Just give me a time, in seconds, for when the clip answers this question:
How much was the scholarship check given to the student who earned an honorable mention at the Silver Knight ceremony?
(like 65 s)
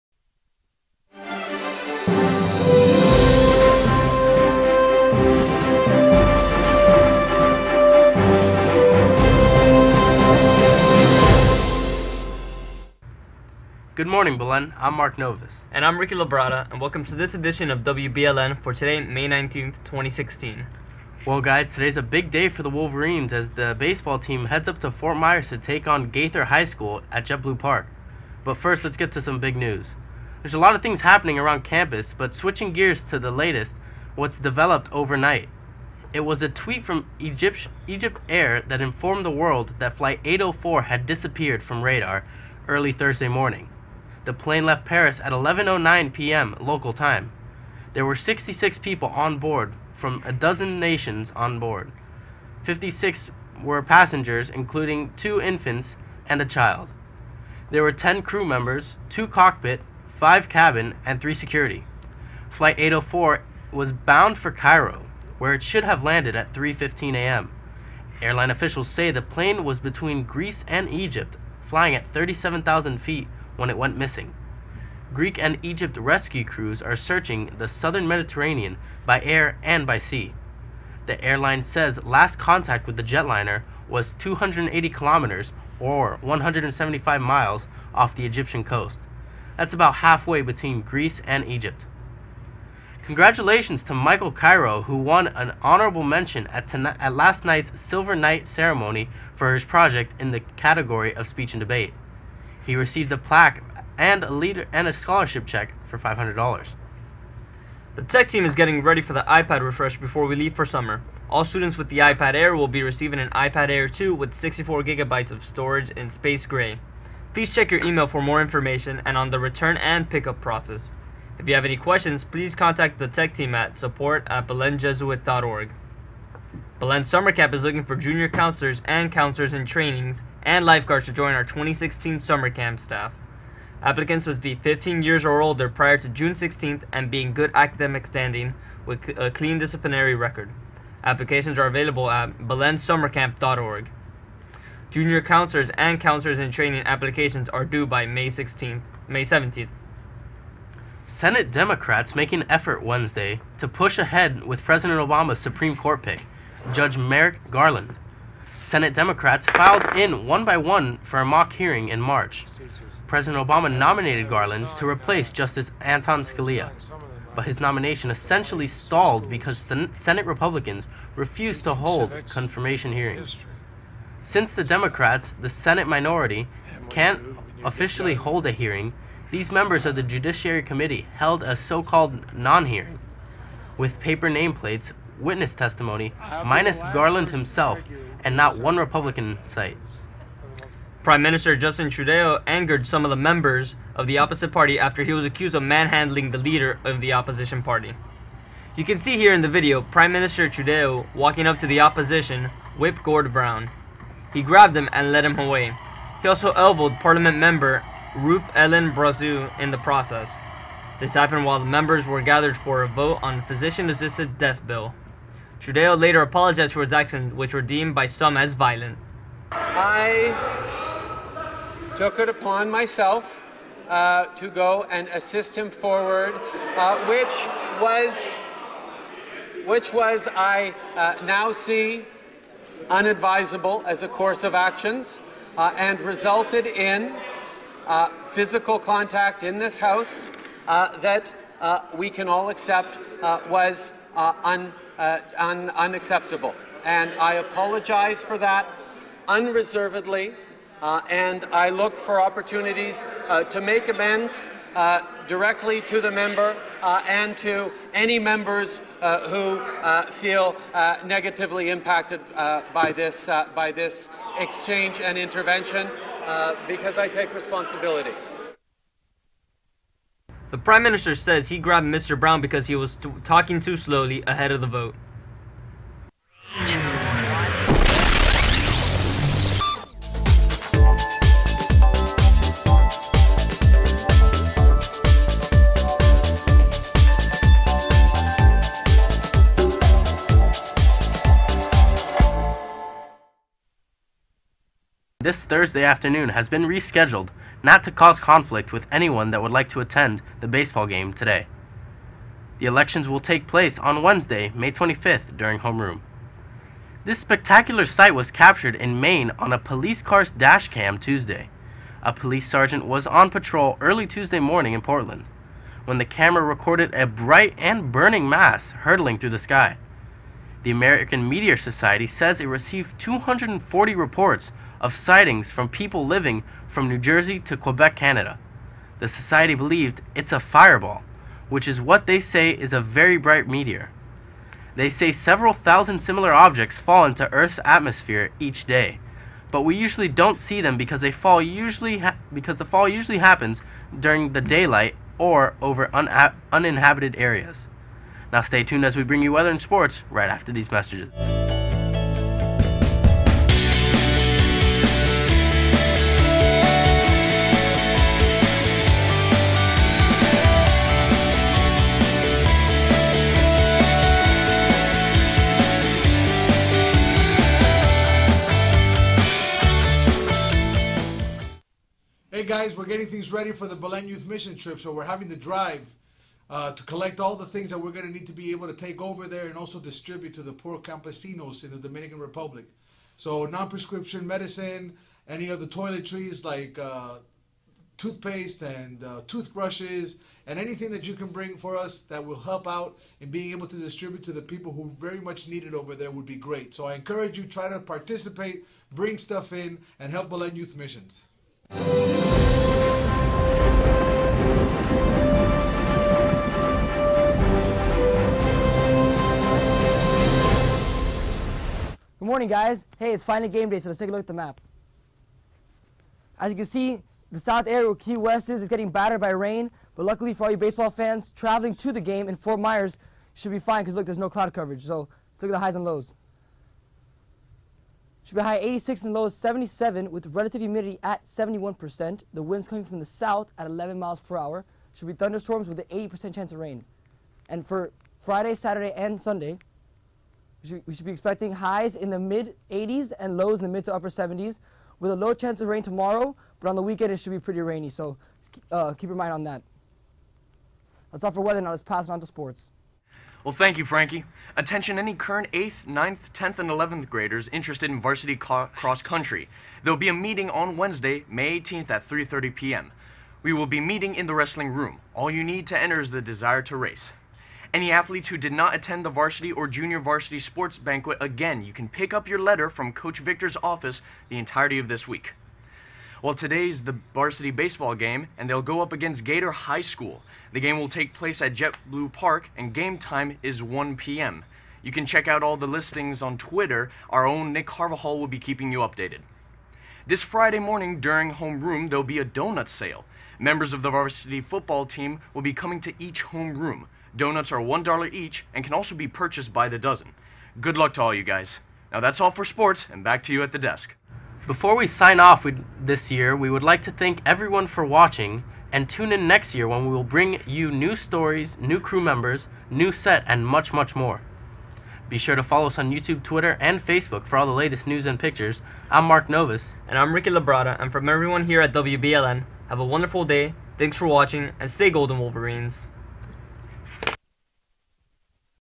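105 s.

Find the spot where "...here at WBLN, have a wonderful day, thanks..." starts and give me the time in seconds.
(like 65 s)
521 s.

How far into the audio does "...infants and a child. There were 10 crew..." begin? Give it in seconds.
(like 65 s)
55 s.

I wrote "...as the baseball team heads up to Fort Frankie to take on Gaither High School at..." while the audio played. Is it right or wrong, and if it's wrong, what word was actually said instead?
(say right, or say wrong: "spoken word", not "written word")
wrong: "Myers", not "Frankie".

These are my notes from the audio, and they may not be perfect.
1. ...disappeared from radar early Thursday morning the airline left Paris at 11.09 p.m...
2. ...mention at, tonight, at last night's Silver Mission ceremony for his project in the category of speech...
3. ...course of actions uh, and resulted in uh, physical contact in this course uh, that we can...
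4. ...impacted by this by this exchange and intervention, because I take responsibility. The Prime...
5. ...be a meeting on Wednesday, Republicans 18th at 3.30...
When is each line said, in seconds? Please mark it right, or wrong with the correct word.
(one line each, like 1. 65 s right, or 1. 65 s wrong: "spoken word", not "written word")
1. 41 s wrong: "plane", not "airline"
2. 96 s wrong: "Knight", not "Mission"
3. 234 s wrong: "house", not "course"
4. 261 s right
5. 459 s wrong: "May", not "Republicans".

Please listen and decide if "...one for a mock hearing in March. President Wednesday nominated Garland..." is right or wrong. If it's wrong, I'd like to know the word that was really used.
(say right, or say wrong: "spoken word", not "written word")
wrong: "Obama", not "Wednesday".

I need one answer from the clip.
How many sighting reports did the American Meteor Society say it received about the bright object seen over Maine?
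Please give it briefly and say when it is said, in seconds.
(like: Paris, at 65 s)
240, at 322 s.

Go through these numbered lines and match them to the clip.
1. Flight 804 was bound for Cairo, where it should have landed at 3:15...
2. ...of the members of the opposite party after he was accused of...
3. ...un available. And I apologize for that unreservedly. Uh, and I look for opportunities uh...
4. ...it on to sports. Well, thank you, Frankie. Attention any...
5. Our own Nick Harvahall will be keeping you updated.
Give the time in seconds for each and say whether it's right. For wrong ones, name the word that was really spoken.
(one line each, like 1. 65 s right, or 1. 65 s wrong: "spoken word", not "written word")
1. 62 s right
2. 193 s right
3. 245 s wrong: "unacceptable", not "available"
4. 452 s right
5. 487 s right.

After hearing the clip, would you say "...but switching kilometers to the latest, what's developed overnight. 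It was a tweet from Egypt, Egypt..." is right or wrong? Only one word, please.
wrong.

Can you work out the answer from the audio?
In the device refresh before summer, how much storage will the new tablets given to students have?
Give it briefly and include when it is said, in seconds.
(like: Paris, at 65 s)
64 gigabytes, at 114 s.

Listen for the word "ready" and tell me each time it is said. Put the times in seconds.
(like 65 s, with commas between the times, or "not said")
108 s, 373 s.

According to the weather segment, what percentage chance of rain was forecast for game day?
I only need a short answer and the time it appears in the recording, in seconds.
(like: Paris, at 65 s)
80%, at 436 s.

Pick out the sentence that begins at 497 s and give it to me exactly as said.
Donuts are $1 each and can also be purchased by the dozen.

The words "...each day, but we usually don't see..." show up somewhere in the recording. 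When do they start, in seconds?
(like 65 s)
338 s.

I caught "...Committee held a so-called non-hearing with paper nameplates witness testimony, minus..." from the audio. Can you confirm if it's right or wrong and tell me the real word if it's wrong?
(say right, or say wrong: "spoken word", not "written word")
right.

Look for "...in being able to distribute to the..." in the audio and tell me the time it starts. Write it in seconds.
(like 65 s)
393 s.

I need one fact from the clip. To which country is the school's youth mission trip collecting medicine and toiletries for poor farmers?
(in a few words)
Dominican Republic.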